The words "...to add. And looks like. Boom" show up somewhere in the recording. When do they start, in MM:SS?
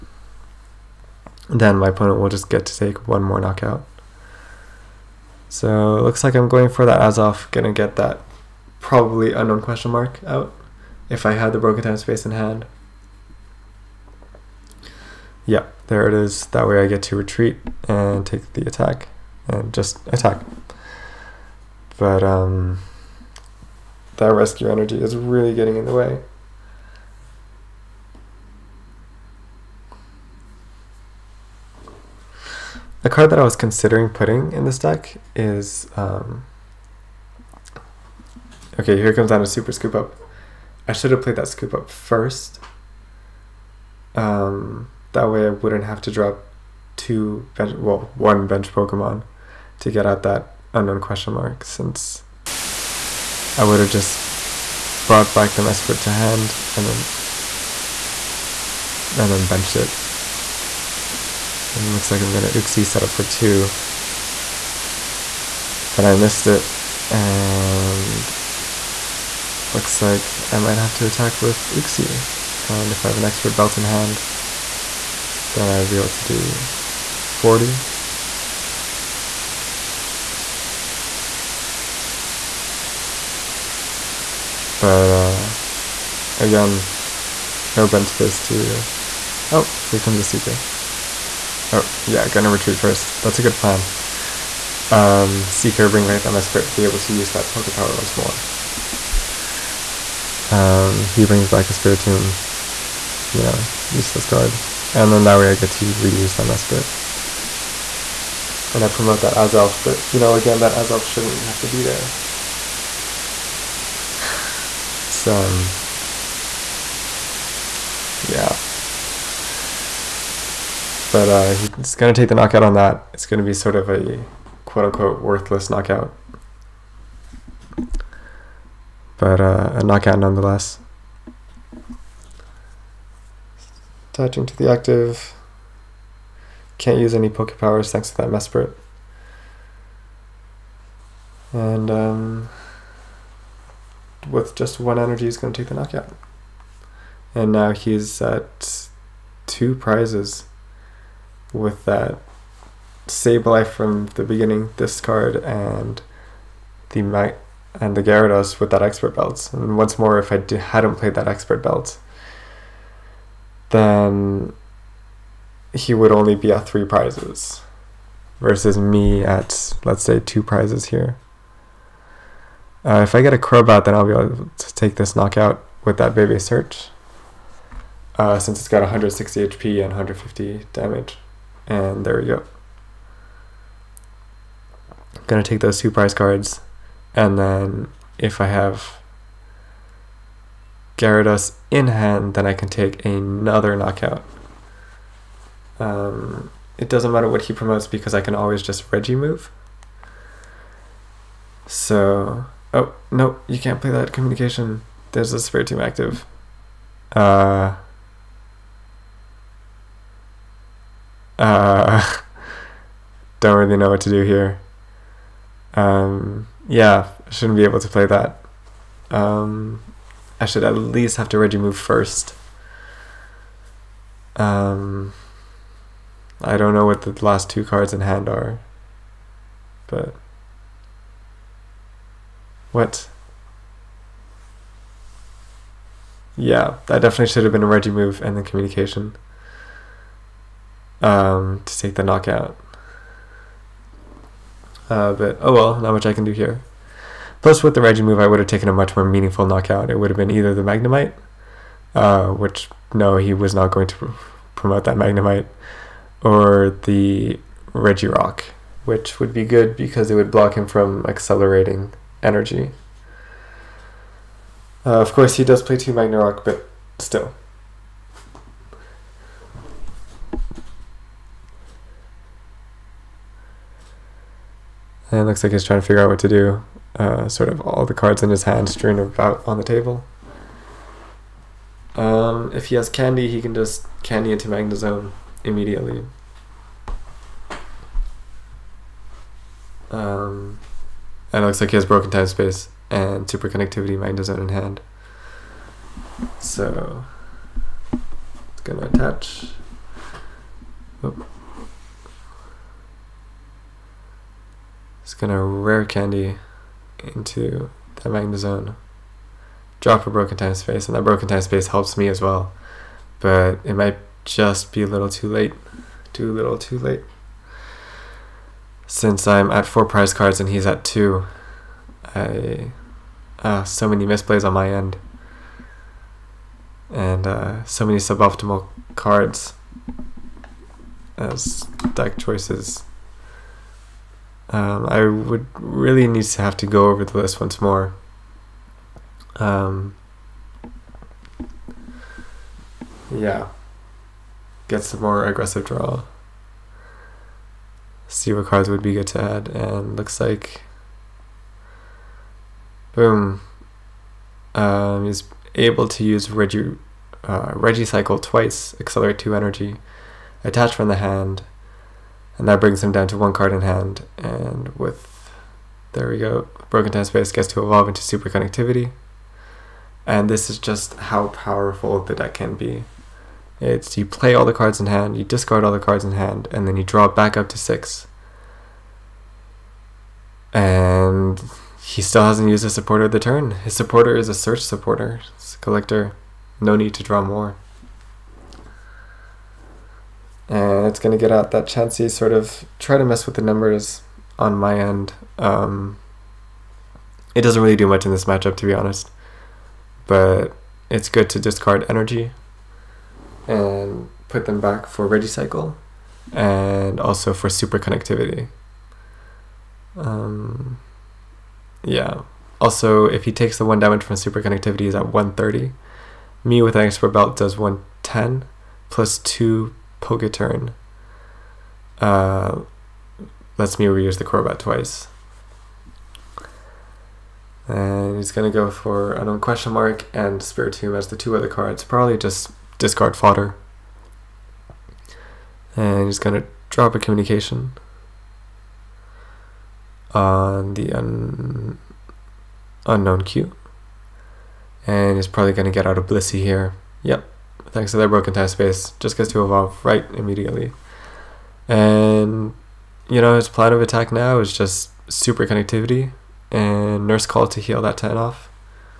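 05:49.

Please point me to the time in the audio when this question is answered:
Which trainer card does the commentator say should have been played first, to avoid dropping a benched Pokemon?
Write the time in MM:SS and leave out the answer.
00:39.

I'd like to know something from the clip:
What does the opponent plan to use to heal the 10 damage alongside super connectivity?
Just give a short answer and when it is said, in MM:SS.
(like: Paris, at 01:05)
Nurse Call, at 07:37.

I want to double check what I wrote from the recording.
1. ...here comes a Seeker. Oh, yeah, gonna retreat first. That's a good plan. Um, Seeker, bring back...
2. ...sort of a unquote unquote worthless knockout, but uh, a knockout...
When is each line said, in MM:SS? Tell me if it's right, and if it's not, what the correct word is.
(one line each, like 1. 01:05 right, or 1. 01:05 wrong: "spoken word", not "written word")
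1. 01:29 right
2. 02:03 wrong: "quote", not "unquote".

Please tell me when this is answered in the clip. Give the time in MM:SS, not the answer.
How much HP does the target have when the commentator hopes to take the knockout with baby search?
02:58.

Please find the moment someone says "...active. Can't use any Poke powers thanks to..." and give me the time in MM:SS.
02:14.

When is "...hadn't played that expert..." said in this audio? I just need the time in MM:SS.
02:40.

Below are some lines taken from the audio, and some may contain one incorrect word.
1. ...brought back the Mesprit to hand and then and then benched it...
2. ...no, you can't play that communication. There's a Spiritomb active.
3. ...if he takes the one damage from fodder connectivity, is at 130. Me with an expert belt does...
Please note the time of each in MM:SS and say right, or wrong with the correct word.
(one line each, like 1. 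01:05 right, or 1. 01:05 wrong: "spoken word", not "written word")
1. 00:55 right
2. 03:23 right
3. 06:53 wrong: "super", not "fodder".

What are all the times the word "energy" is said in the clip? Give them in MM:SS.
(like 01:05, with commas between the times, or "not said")
00:24, 02:24, 04:22, 05:59, 06:41.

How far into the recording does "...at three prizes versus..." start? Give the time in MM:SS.
02:46.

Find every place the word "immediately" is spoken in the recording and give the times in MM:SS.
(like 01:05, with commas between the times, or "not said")
04:45, 07:30.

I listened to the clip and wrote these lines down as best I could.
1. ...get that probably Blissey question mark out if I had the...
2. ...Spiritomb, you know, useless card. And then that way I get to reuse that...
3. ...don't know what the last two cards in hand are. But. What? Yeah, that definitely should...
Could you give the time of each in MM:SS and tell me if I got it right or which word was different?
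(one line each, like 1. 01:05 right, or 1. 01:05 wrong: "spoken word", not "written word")
1. 00:07 wrong: "Unown", not "Blissey"
2. 01:41 right
3. 03:46 right.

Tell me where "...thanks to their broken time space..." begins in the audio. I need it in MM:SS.
07:27.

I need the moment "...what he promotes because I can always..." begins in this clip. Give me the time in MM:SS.
03:17.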